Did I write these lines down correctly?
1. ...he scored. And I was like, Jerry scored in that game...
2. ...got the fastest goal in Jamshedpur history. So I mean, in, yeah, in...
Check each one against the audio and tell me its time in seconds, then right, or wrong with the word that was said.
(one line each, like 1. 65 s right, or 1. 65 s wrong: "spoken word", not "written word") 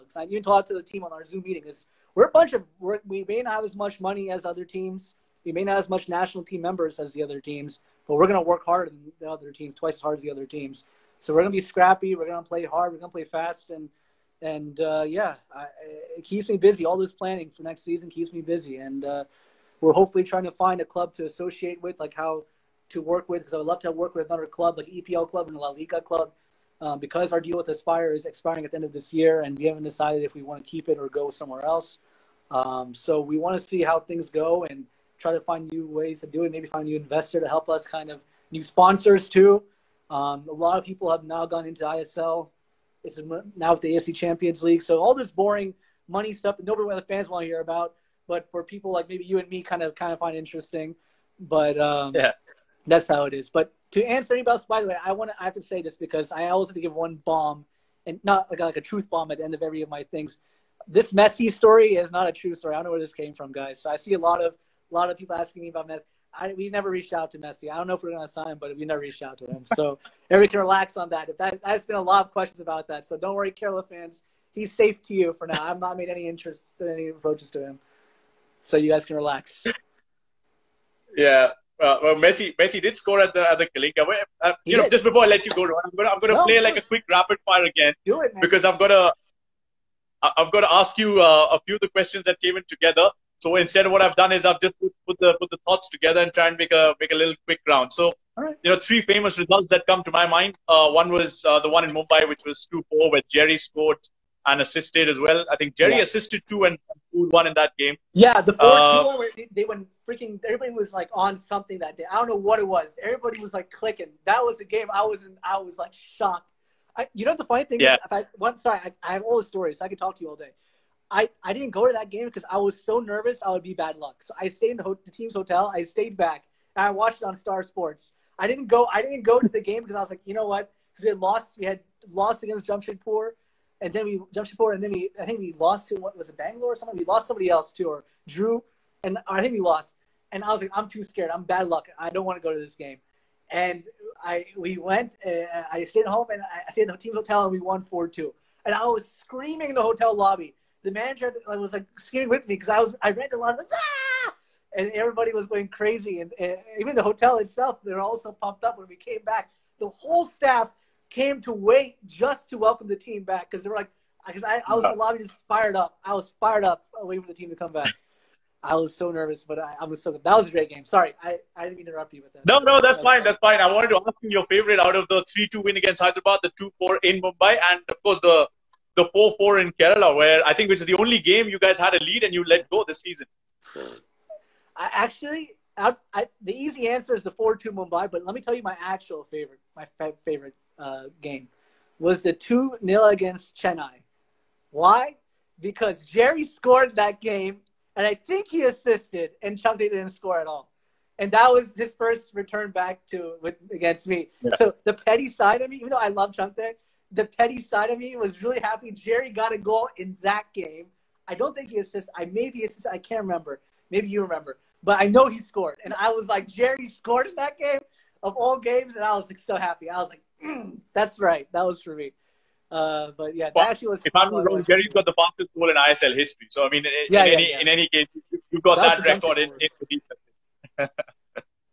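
1. 215 s right
2. 224 s wrong: "ISL", not "Jamshedpur".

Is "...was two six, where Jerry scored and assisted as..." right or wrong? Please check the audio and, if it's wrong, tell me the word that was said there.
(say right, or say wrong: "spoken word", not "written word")
wrong: "four", not "six".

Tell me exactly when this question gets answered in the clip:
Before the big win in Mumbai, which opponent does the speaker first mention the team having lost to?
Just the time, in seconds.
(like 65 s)
132 s.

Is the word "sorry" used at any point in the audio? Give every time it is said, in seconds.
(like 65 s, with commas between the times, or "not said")
118 s, 170 s.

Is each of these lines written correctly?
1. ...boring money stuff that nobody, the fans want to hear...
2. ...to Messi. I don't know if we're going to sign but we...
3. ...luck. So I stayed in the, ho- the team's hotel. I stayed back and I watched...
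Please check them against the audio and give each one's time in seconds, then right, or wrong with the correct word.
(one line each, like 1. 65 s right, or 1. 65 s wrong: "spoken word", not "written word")
1. 45 s right
2. 67 s right
3. 123 s right.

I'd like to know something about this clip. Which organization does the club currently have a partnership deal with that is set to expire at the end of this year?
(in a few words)
Aspire.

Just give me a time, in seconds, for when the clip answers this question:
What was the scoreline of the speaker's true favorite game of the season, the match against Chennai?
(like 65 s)
192 s.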